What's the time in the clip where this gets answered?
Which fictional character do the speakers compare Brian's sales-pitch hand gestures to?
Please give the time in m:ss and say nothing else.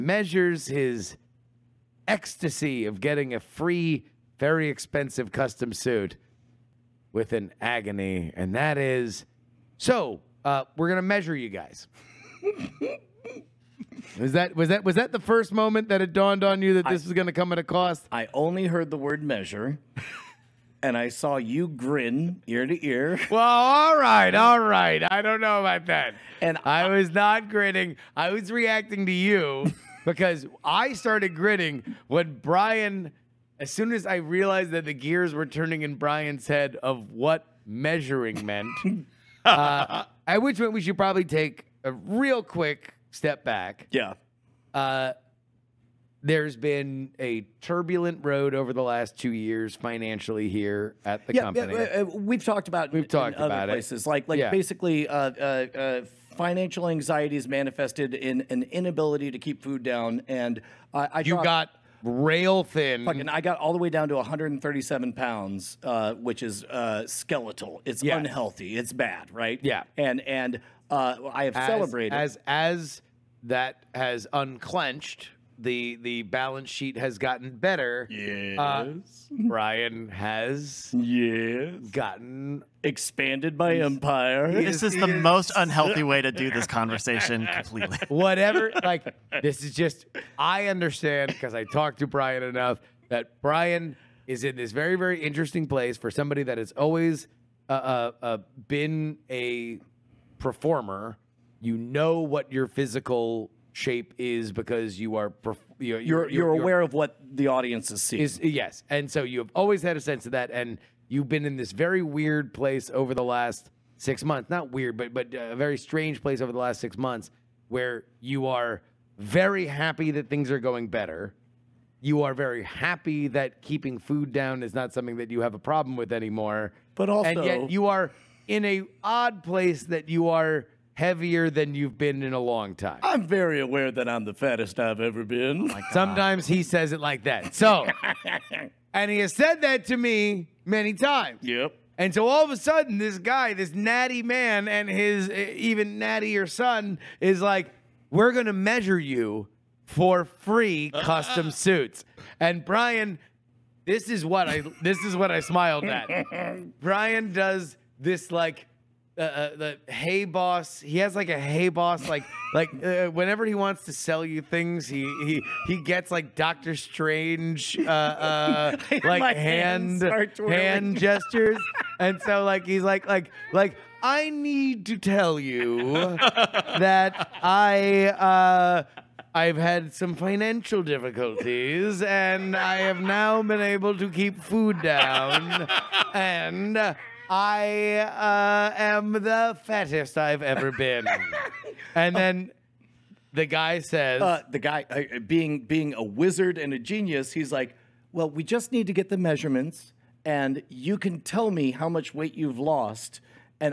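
2:46.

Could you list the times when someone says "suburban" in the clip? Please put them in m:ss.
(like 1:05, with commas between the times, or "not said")
not said.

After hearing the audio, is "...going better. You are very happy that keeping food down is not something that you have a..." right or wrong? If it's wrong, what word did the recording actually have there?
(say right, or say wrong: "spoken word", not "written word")
right.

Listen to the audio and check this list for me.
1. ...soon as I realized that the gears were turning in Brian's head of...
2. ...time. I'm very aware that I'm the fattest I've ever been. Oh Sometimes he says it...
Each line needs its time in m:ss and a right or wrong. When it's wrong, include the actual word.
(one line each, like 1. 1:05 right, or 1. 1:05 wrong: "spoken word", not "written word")
1. 0:33 right
2. 2:12 right.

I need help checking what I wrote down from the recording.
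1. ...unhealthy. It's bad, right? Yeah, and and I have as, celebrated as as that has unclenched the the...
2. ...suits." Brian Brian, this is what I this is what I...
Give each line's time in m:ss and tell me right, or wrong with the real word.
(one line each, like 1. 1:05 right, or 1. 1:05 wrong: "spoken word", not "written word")
1. 1:08 right
2. 2:31 wrong: "And", not "Brian".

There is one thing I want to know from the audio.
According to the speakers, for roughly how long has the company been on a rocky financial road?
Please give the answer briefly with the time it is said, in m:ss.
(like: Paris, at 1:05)
2 years, at 0:49.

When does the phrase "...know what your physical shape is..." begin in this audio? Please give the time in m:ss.
1:41.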